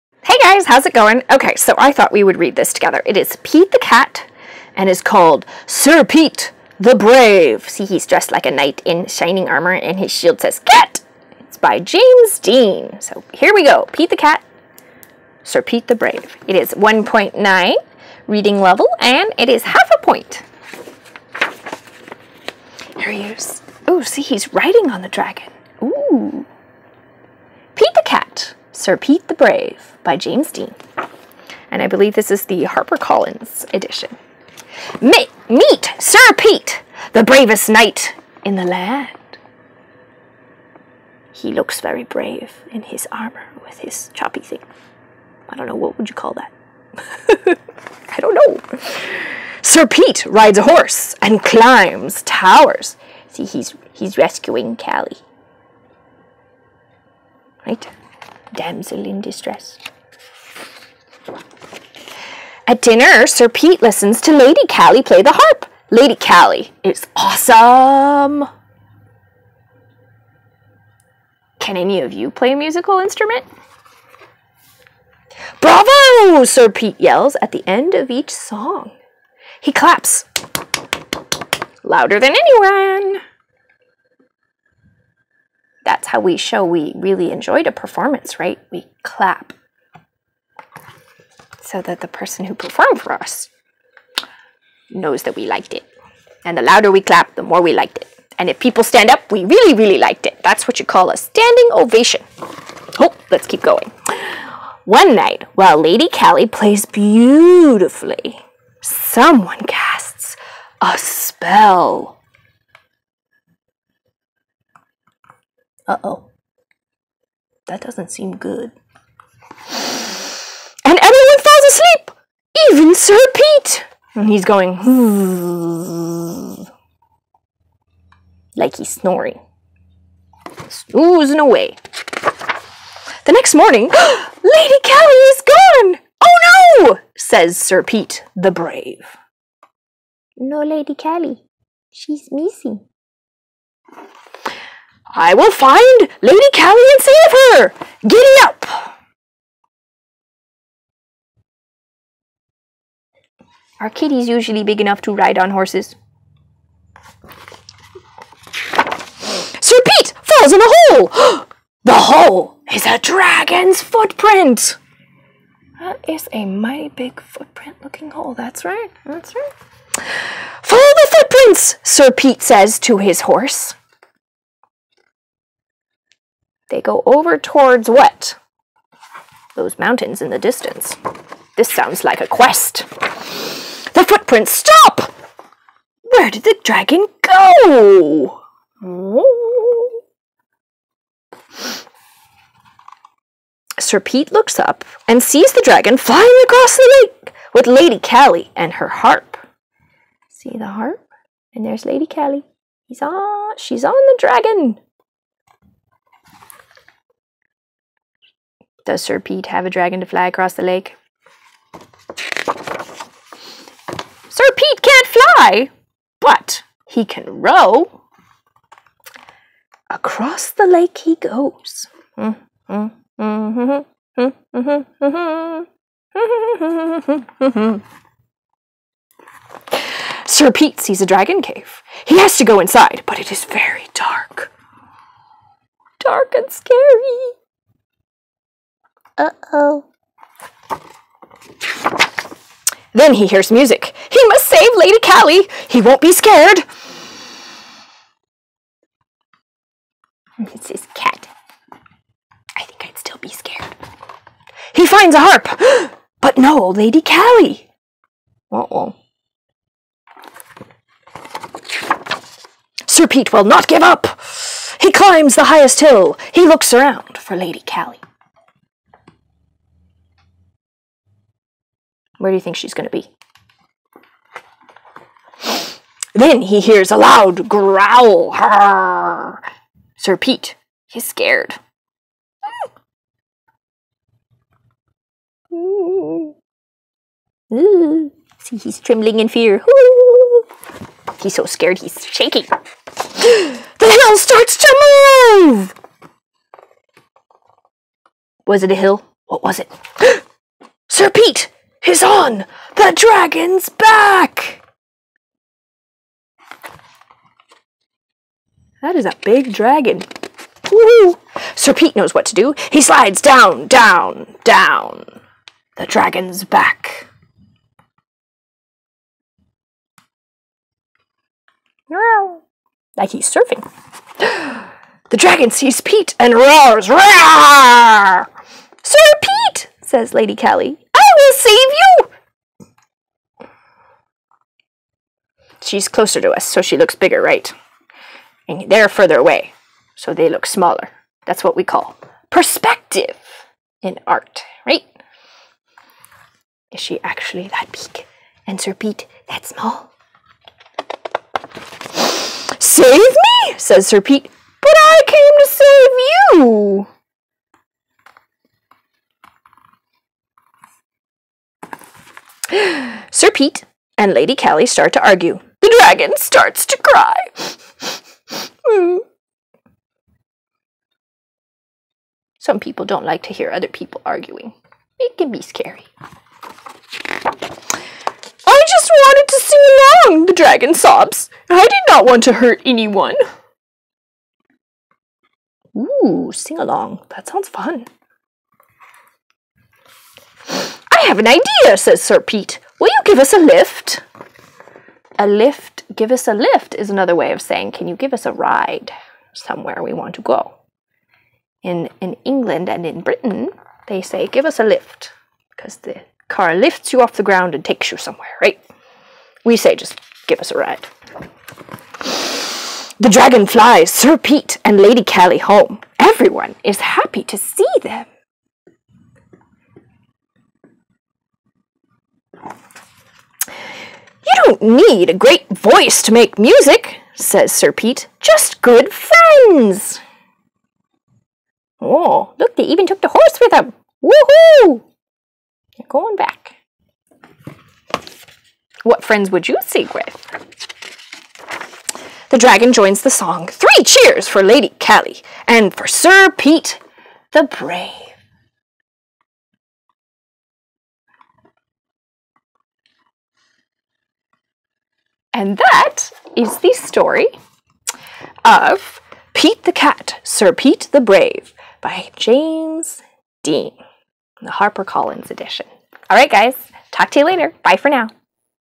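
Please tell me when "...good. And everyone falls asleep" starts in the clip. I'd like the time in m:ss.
1:58.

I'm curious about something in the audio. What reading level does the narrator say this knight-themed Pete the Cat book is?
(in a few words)
1.9.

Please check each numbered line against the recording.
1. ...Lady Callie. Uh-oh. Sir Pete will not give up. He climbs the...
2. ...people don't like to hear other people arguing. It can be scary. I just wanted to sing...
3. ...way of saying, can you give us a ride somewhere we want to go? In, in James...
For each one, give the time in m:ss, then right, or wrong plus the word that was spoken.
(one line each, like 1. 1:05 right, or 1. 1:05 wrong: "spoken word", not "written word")
1. 4:16 right
2. 6:12 right
3. 6:37 wrong: "England", not "James".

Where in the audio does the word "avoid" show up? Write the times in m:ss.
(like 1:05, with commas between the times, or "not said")
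not said.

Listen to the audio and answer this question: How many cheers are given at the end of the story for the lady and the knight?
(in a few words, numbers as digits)
3.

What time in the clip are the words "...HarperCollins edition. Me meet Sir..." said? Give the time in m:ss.
0:32.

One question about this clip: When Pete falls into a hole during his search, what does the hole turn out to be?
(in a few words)
A dragon's footprint.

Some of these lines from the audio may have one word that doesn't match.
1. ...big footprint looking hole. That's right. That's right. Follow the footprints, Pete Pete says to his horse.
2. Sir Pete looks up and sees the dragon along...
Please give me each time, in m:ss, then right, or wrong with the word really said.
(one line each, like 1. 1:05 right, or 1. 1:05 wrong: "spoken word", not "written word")
1. 2:46 wrong: "Sir", not "Pete"
2. 3:13 wrong: "flying", not "along".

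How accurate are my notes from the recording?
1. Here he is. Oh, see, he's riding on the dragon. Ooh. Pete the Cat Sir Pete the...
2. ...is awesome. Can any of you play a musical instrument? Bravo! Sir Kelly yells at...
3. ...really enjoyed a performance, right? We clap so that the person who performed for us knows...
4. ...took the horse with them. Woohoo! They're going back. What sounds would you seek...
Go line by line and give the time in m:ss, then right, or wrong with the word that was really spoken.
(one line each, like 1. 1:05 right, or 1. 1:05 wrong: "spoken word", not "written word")
1. 0:22 right
2. 1:06 wrong: "Pete", not "Kelly"
3. 1:26 right
4. 7:12 wrong: "friends", not "sounds".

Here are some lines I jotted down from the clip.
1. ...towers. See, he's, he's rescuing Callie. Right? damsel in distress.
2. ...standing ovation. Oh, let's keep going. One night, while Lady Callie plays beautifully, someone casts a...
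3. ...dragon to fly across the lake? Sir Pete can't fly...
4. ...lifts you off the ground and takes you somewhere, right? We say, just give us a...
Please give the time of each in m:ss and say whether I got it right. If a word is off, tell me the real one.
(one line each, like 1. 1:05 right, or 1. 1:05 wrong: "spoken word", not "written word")
1. 0:52 right
2. 1:41 right
3. 3:29 right
4. 6:46 right.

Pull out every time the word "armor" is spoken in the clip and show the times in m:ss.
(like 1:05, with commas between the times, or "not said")
0:09, 0:43.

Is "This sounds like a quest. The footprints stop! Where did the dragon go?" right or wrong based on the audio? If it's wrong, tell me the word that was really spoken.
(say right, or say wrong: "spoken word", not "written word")
right.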